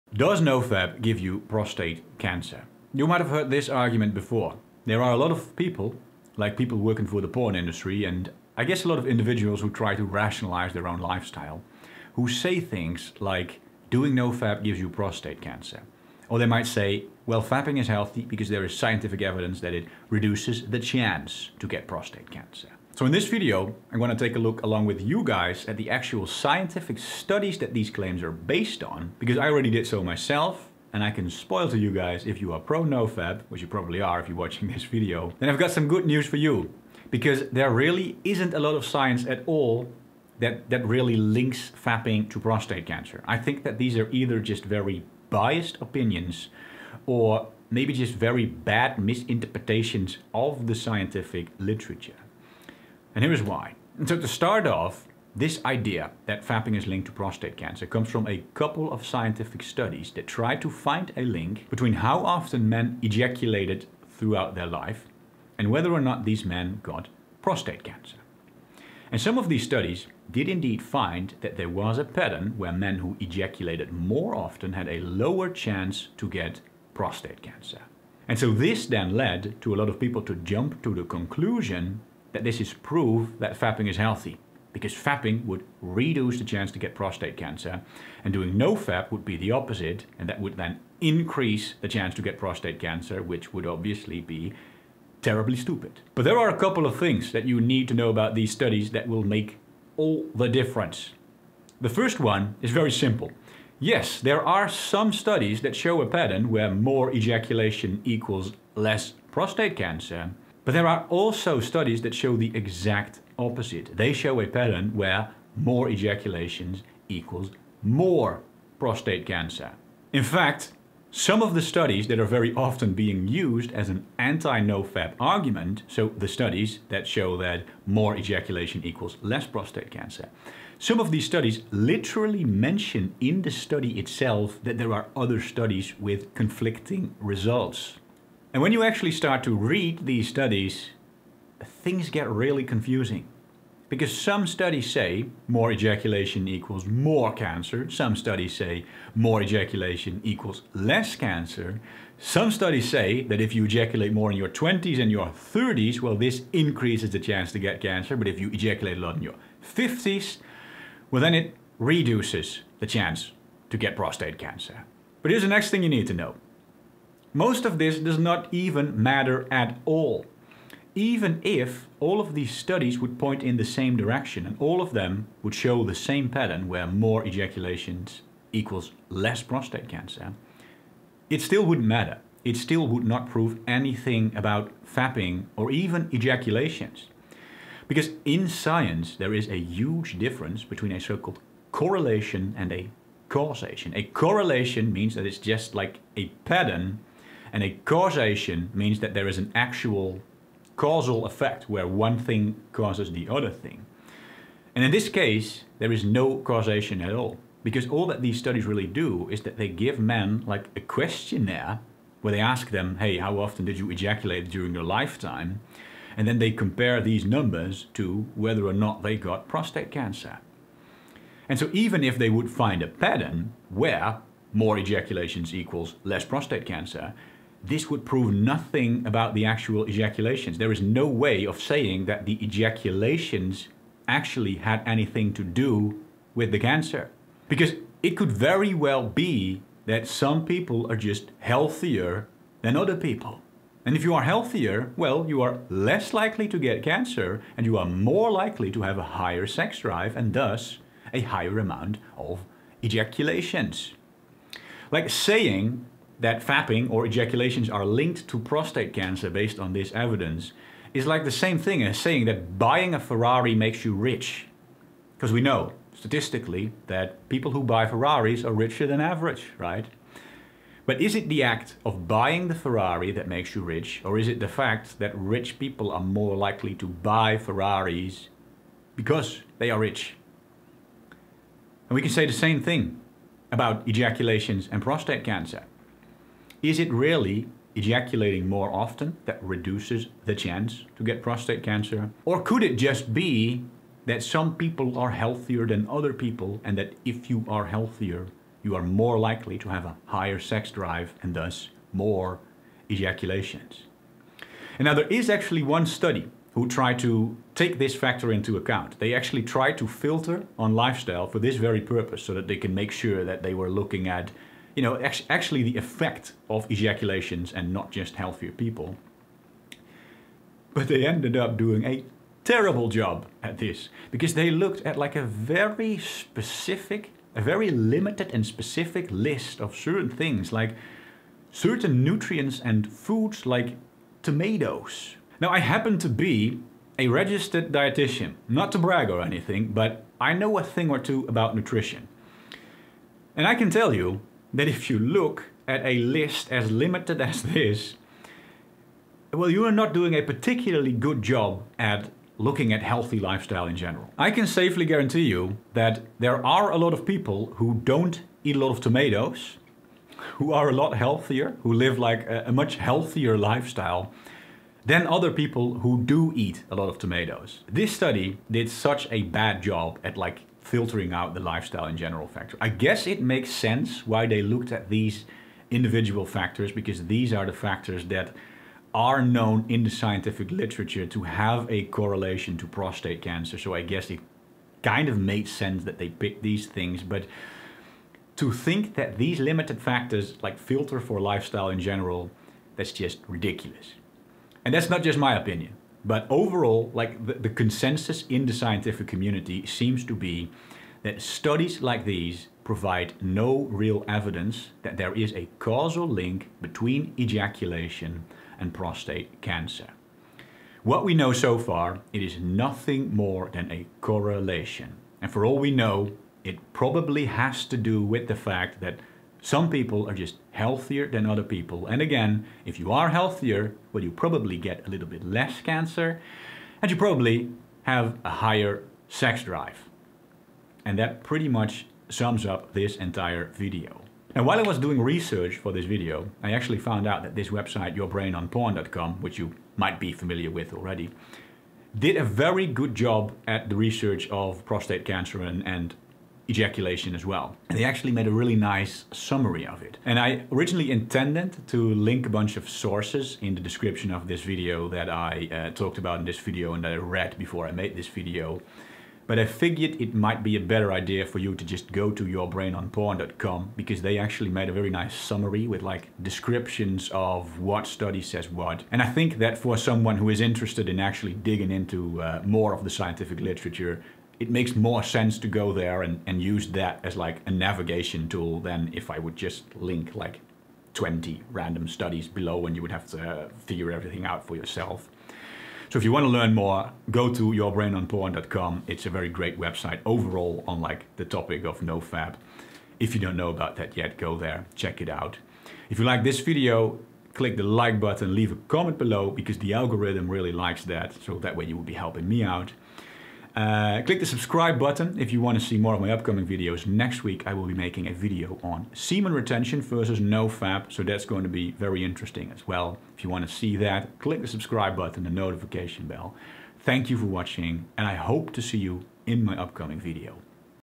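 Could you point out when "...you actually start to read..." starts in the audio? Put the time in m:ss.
2:18.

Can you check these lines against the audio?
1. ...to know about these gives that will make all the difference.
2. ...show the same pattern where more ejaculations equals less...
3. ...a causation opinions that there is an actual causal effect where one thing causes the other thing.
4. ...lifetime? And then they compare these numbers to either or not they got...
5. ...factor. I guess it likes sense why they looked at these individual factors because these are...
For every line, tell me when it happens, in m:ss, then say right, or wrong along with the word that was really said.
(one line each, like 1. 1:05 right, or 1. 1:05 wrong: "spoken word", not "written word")
1. 1:37 wrong: "studies", not "gives"
2. 2:55 right
3. 3:17 wrong: "means", not "opinions"
4. 3:34 wrong: "whether", not "either"
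5. 6:12 wrong: "makes", not "likes".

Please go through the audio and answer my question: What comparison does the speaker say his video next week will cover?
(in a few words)
semen retention versus no-fap.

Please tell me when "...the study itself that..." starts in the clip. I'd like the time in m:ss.
2:13.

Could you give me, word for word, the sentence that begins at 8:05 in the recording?
So if you want to learn more, go to yourbrainonporn.com.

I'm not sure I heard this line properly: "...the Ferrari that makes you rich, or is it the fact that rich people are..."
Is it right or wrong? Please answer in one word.
right.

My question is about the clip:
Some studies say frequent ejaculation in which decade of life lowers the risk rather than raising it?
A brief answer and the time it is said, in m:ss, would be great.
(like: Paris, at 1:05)
50s, at 2:39.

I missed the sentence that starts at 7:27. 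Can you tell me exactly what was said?
And they actually made a really nice summary of it.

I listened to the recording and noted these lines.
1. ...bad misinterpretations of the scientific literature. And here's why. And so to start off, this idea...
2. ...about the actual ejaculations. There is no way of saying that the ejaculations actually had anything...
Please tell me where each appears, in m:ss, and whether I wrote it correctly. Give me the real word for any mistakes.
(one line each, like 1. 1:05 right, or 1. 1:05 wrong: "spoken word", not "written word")
1. 0:48 right
2. 3:49 right.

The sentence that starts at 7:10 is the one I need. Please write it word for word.
And that pretty much sums up this entire video.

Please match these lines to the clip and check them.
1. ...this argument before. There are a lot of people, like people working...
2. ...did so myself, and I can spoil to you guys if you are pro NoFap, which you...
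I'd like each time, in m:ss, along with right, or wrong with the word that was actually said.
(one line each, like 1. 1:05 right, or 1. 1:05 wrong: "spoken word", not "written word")
1. 0:03 right
2. 0:29 right.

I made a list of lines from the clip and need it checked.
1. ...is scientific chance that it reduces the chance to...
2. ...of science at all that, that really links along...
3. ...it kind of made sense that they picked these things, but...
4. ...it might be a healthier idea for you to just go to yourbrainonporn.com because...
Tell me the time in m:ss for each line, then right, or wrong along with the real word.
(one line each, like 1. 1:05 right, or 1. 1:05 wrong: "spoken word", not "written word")
1. 0:18 wrong: "evidence", not "chance"
2. 0:38 wrong: "fapping", not "along"
3. 6:24 right
4. 7:40 wrong: "better", not "healthier".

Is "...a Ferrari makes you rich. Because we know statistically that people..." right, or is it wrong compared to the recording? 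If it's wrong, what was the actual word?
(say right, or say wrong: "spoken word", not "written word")
right.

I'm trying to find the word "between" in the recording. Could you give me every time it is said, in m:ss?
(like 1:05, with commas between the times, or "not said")
1:01, 3:10, 6:46.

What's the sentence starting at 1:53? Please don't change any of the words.
They show a pattern where more ejaculations equals more prostate cancer.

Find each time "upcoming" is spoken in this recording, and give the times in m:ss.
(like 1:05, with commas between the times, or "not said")
8:26, 8:39.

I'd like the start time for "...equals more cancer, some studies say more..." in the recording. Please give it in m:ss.
2:26.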